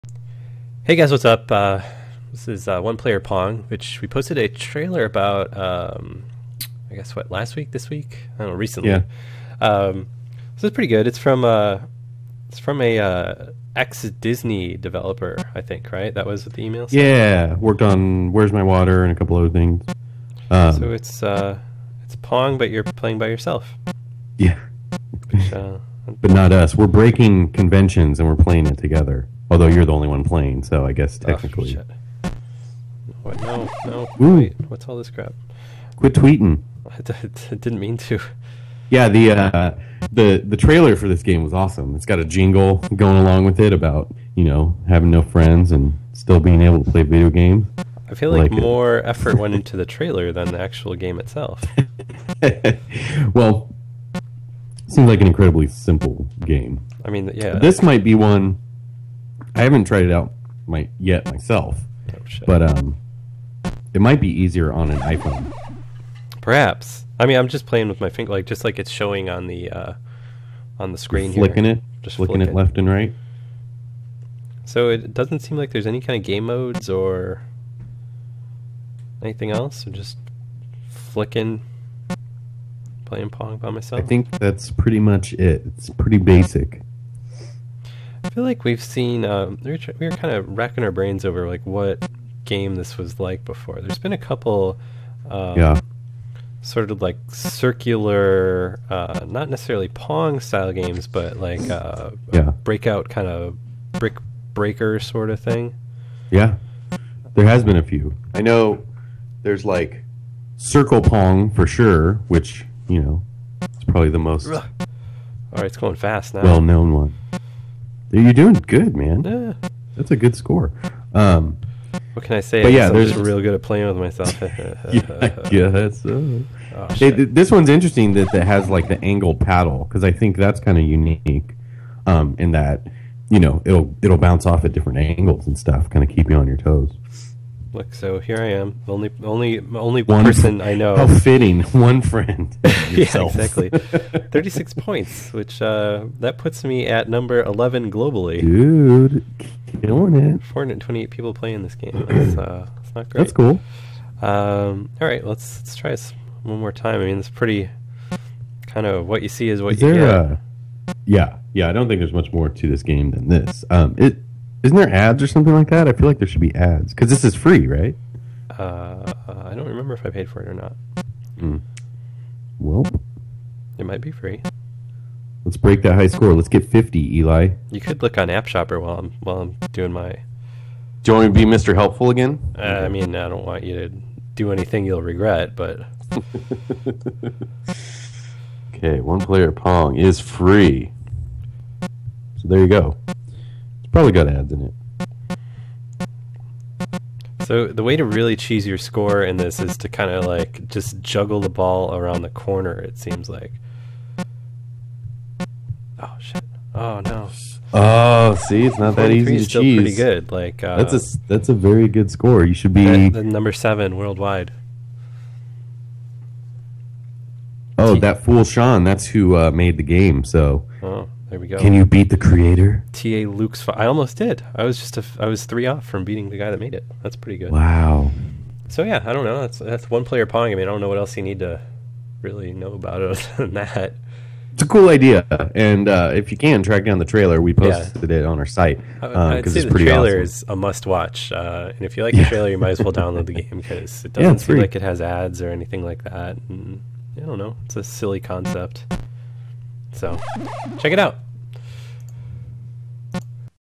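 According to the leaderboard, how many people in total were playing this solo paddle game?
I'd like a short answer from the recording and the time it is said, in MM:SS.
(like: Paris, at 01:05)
428, at 02:30.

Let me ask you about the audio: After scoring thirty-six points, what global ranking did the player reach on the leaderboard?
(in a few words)
11.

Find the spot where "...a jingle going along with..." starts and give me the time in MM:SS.
00:42.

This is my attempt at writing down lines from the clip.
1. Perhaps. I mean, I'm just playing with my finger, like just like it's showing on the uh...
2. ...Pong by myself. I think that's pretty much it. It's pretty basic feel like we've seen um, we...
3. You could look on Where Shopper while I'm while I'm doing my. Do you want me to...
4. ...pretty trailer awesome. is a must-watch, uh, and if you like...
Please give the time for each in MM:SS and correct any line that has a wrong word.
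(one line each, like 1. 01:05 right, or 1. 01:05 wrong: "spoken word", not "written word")
1. 01:06 right
2. 01:23 right
3. 02:57 wrong: "App", not "Where"
4. 03:59 right.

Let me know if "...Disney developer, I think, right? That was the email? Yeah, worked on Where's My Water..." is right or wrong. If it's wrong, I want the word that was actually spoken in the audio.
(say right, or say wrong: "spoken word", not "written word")
right.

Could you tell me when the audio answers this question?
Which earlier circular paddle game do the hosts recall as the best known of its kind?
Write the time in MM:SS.
01:50.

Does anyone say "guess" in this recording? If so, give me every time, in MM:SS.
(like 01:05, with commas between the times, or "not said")
00:06, 00:30.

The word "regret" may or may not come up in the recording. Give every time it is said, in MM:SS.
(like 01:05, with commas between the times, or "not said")
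03:05.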